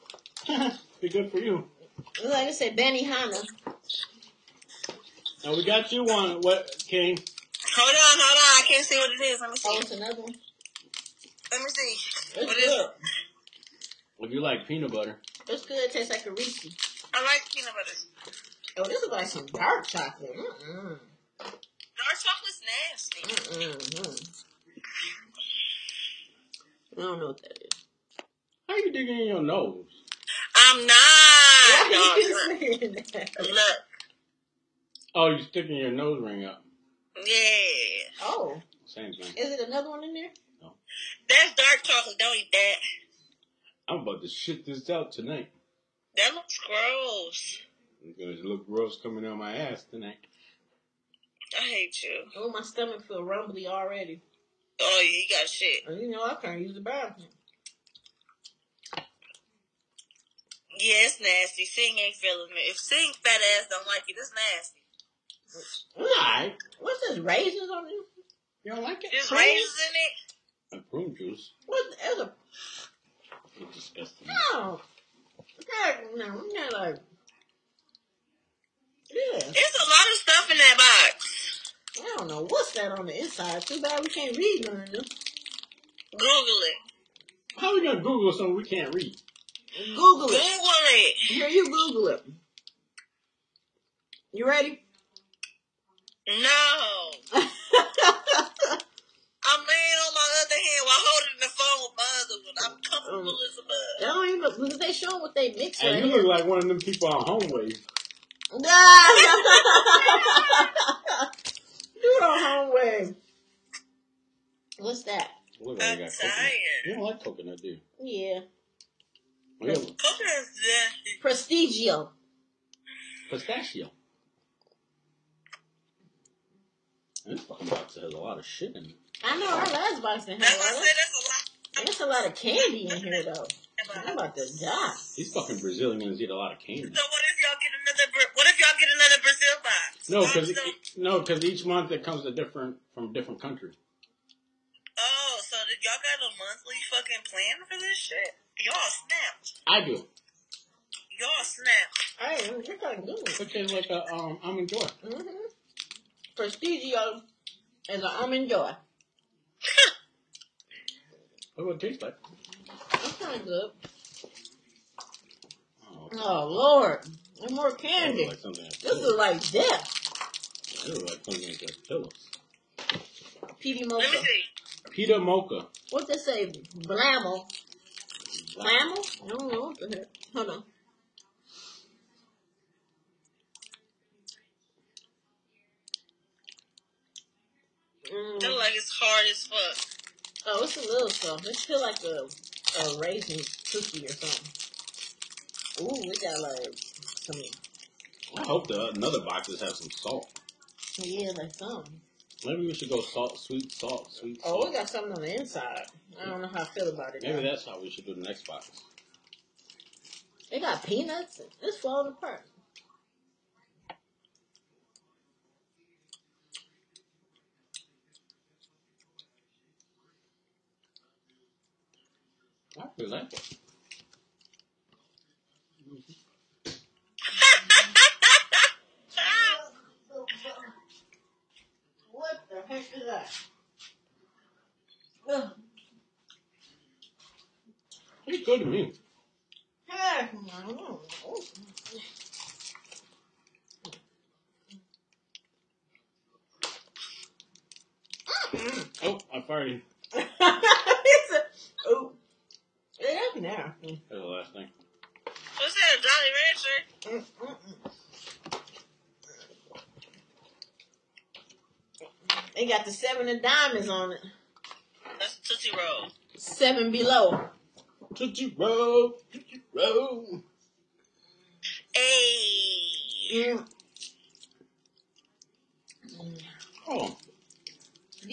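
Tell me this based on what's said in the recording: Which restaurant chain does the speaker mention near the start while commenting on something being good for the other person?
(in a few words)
Benihana.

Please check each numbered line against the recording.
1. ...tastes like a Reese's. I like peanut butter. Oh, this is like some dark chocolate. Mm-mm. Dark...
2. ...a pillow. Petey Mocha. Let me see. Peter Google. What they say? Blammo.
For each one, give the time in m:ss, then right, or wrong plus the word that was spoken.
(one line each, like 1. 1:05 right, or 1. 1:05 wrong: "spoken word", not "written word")
1. 0:15 right
2. 2:51 wrong: "Mocha", not "Google".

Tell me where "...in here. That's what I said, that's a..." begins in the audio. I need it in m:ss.
2:10.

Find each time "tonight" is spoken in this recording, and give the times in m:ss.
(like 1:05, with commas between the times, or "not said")
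0:45, 0:49.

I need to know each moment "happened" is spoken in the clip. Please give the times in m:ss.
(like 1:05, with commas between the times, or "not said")
4:13.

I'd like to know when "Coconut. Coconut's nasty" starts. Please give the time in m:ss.
1:59.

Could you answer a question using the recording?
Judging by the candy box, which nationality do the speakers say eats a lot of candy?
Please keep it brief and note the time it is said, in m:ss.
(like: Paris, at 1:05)
Brazilians, at 2:15.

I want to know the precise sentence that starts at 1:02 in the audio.
If Sing fat ass don't like it, it's nasty.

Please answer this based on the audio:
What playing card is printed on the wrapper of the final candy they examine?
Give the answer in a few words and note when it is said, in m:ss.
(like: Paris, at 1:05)
Seven of diamonds, at 4:22.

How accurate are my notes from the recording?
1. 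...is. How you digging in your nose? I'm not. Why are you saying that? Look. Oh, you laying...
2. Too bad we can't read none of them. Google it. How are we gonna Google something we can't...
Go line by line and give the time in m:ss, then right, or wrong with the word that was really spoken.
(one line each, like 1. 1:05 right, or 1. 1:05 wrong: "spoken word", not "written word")
1. 0:27 wrong: "sticking", not "laying"
2. 1:23 right.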